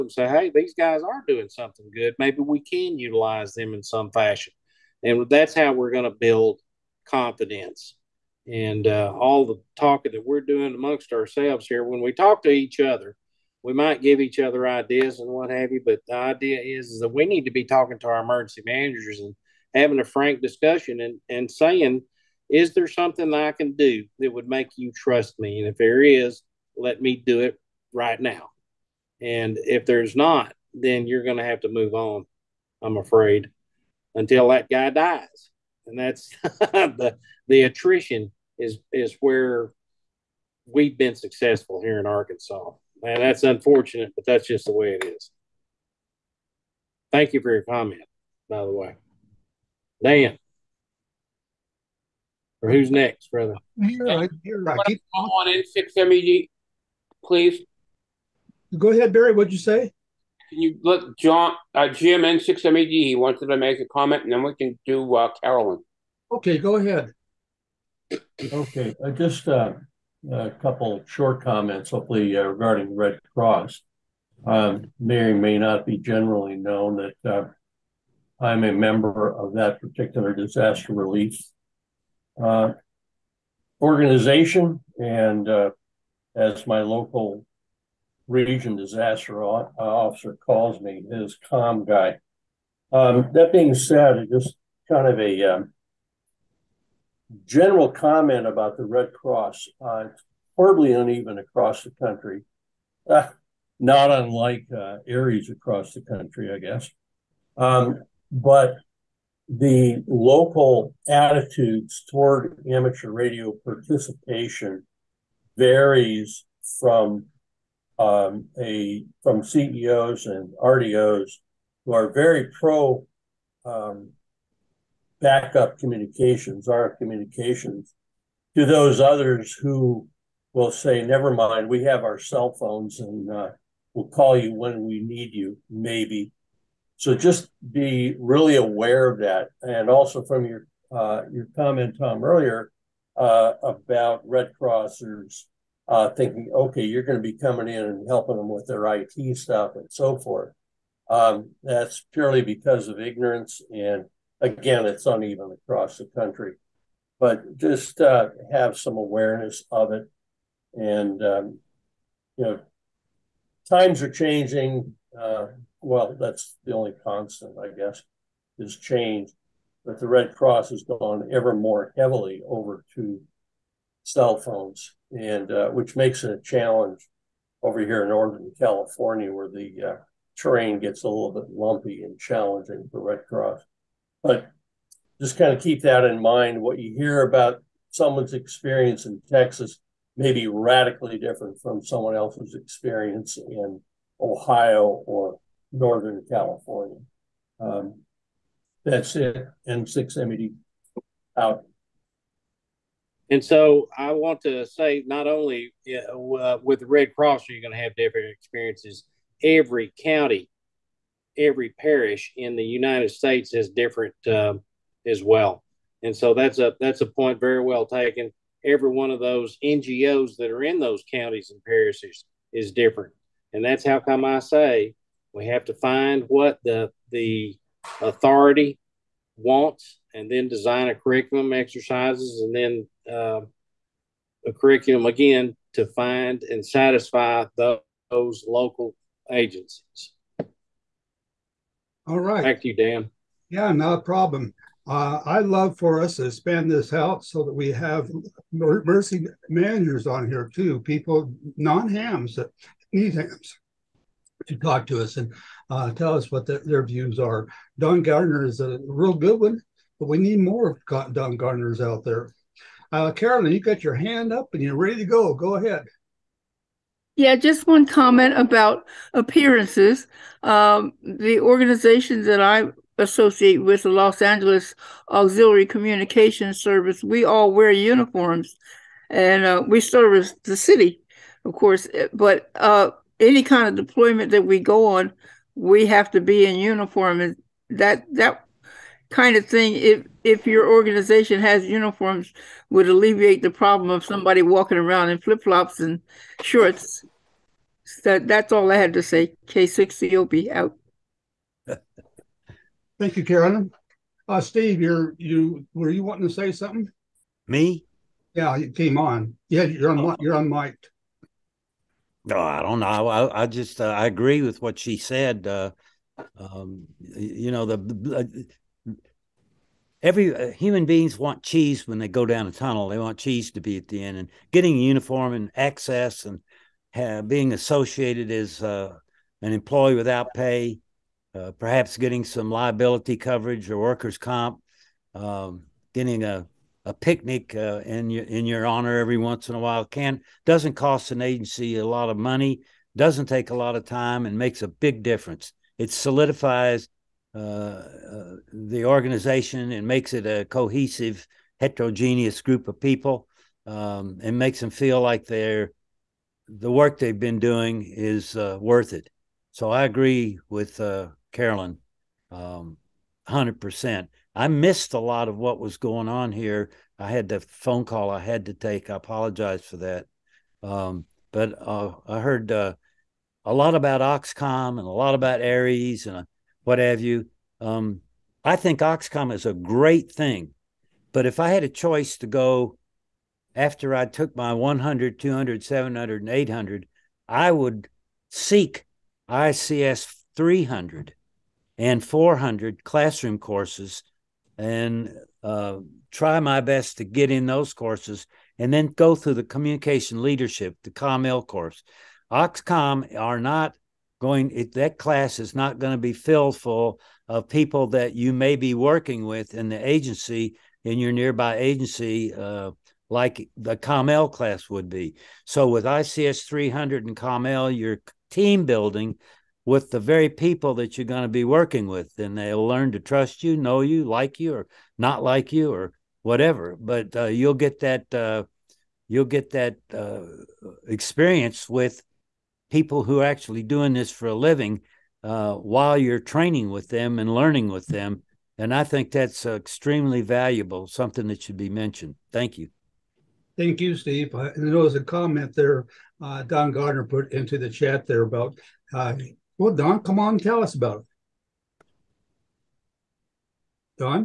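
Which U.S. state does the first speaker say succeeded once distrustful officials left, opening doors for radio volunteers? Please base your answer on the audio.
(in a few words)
Arkansas.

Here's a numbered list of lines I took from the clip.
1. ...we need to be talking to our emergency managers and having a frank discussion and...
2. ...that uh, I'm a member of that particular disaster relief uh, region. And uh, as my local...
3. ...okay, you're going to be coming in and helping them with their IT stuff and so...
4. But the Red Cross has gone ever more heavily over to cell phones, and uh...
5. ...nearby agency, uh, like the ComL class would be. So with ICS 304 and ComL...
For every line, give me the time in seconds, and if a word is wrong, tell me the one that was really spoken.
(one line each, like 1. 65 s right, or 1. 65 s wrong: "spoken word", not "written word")
1. 17 s right
2. 77 s wrong: "organization", not "region"
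3. 146 s right
4. 169 s right
5. 411 s wrong: "300", not "304".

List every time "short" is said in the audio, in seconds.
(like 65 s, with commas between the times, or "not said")
71 s, 296 s.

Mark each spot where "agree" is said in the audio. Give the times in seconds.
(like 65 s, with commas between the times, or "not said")
314 s, 359 s.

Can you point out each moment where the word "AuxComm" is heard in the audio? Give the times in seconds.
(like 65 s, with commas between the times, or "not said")
374 s, 378 s, 402 s.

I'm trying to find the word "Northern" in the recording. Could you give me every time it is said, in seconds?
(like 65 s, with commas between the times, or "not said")
178 s, 195 s.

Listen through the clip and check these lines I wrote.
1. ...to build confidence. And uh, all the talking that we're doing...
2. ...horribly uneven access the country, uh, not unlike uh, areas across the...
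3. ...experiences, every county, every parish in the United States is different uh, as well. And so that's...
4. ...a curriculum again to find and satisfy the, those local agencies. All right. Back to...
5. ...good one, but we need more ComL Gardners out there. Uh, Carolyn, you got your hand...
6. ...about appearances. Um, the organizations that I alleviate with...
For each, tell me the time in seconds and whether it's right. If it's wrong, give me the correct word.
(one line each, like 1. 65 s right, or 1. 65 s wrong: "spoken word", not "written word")
1. 6 s right
2. 100 s wrong: "across", not "access"
3. 208 s right
4. 234 s right
5. 259 s wrong: "Don", not "ComL"
6. 268 s wrong: "associate", not "alleviate".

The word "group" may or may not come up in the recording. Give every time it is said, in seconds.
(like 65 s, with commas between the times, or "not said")
352 s.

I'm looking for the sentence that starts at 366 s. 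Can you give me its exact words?
I had the phone call I had to take.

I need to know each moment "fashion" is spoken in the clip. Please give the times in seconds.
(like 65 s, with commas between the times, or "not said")
4 s.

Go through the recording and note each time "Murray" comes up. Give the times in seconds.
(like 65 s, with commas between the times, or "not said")
not said.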